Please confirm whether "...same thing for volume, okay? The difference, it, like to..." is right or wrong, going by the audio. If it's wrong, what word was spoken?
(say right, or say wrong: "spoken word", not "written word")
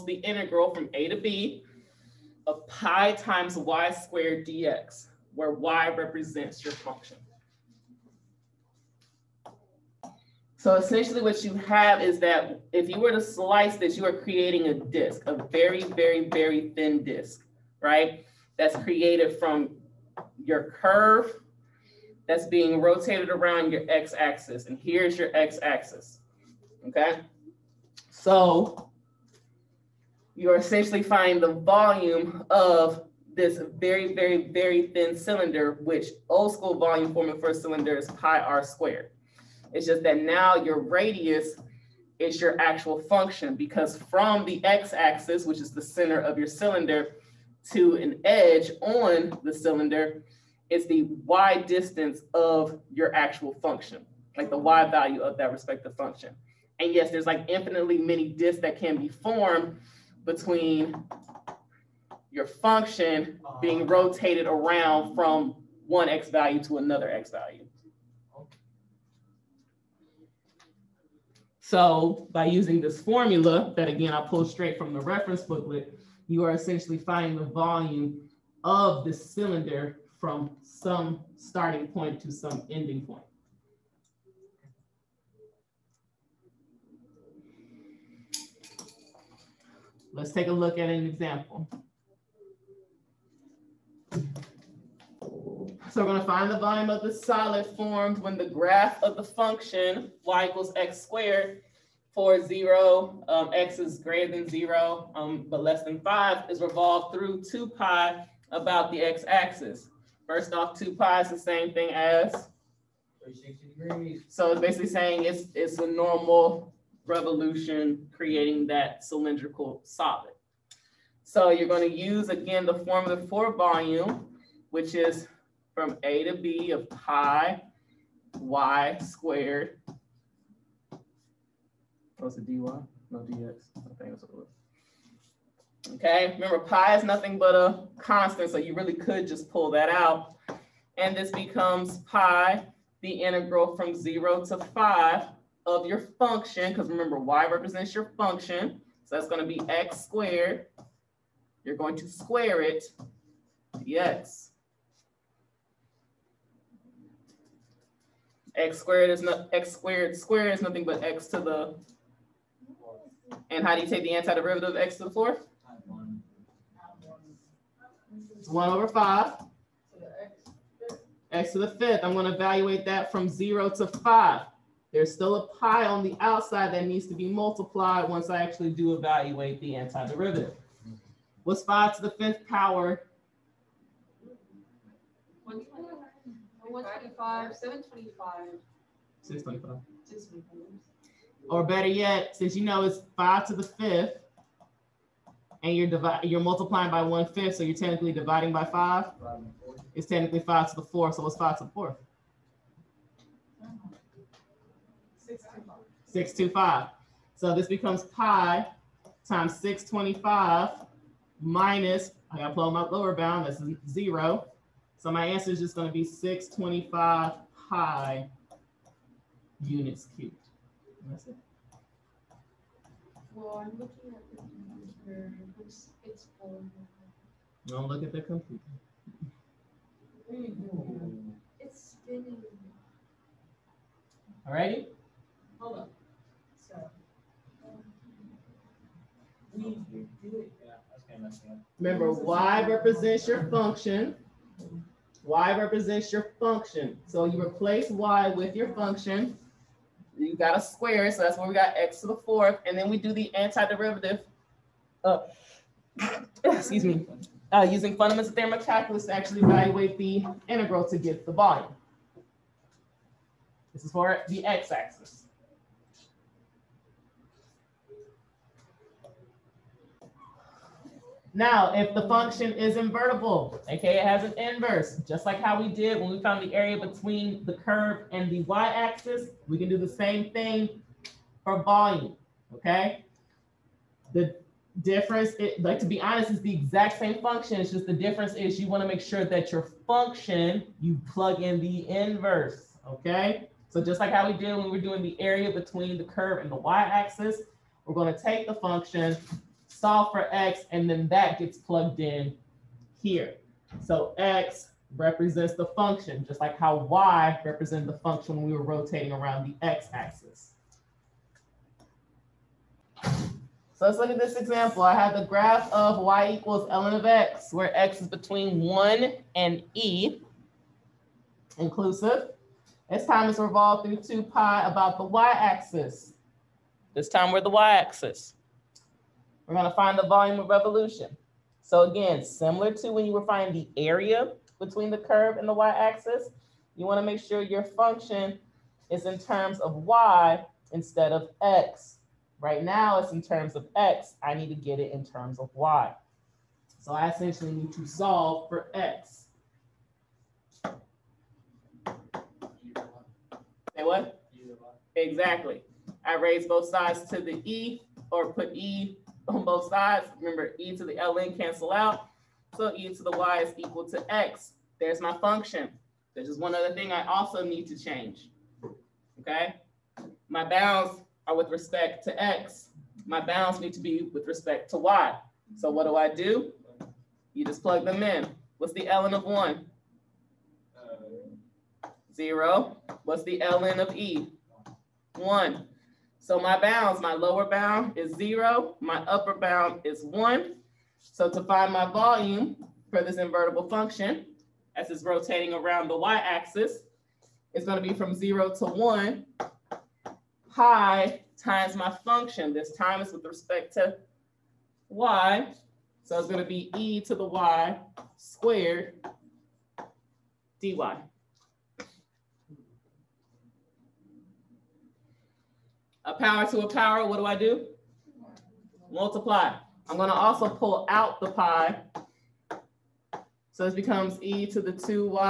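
right.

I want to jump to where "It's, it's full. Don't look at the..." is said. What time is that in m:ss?
3:45.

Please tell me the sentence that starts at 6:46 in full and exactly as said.
So it's gonna be e to the y squared dy.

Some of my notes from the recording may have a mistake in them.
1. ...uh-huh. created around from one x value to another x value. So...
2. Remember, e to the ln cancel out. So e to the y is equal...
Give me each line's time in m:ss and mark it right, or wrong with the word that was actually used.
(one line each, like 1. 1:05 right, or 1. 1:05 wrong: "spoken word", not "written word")
1. 1:03 wrong: "rotated", not "created"
2. 6:00 right.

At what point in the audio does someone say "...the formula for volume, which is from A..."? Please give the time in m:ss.
2:02.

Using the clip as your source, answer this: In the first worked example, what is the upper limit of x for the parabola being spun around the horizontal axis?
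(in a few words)
5.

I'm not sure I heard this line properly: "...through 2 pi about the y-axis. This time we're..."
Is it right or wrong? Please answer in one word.
right.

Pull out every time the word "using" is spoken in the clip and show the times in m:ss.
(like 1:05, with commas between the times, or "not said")
1:12, 4:17.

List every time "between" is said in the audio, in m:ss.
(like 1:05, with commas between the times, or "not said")
1:00, 4:36, 4:55, 5:18, 5:34.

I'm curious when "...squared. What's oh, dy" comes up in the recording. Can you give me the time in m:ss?
2:09.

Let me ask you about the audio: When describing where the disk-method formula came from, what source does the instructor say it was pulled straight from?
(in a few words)
reference booklet.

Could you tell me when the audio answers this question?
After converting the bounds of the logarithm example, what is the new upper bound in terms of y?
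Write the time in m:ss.
6:28.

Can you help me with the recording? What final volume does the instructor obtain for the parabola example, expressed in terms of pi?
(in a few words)
625 pi.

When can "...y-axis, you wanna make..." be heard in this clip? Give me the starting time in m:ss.
5:35.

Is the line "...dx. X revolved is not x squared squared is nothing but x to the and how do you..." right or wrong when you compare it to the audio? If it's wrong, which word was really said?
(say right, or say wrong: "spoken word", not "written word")
wrong: "squared", not "revolved".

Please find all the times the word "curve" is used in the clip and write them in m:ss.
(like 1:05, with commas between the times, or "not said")
0:20, 4:37, 4:56, 5:34.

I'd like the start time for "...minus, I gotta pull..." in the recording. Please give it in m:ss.
3:31.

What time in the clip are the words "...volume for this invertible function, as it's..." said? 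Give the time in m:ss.
6:31.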